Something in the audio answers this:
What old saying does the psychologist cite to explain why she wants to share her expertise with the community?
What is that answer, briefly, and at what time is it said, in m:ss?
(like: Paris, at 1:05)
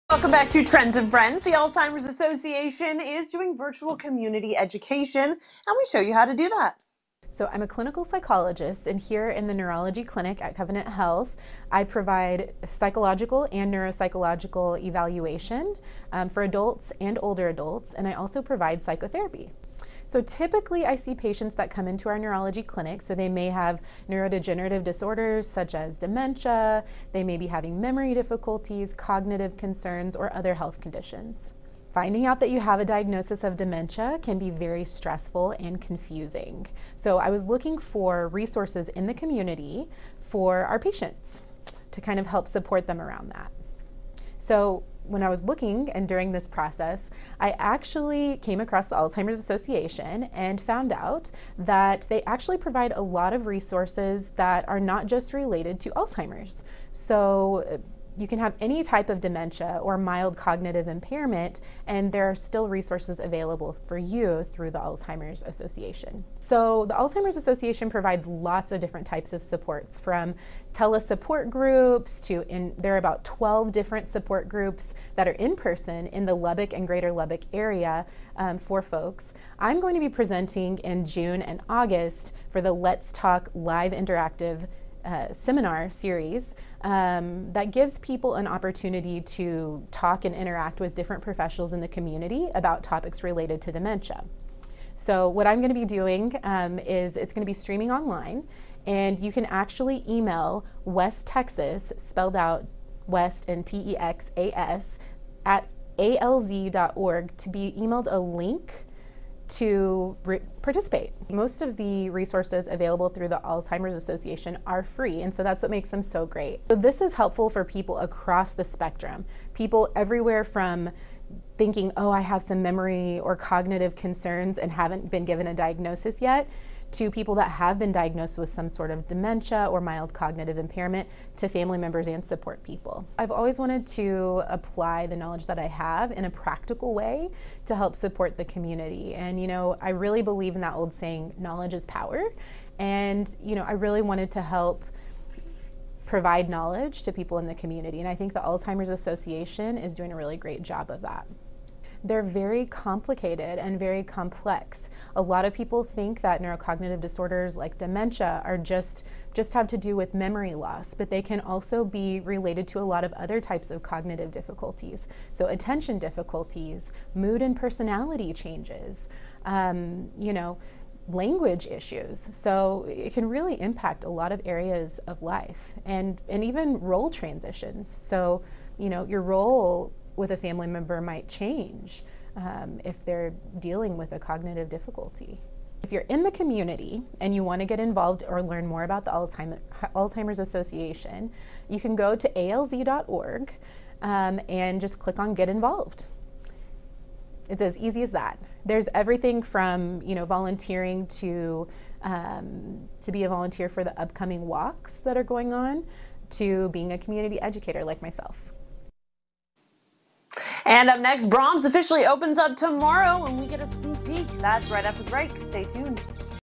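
Knowledge is power, at 2:21.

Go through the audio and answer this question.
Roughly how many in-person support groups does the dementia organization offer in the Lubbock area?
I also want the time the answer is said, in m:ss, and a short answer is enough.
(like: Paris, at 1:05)
12, at 1:13.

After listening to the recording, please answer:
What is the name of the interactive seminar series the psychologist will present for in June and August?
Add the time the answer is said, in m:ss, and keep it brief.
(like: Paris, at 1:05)
Let's Talk Live, at 1:22.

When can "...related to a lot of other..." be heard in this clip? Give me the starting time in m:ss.
2:42.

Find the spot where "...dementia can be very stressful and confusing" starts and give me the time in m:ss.
0:33.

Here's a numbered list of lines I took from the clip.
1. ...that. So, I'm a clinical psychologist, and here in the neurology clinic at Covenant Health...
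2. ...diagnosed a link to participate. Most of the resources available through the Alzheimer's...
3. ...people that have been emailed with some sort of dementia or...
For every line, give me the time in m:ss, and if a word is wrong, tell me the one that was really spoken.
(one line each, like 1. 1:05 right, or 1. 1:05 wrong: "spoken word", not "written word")
1. 0:06 right
2. 1:47 wrong: "emailed", not "diagnosed"
3. 2:07 wrong: "diagnosed", not "emailed".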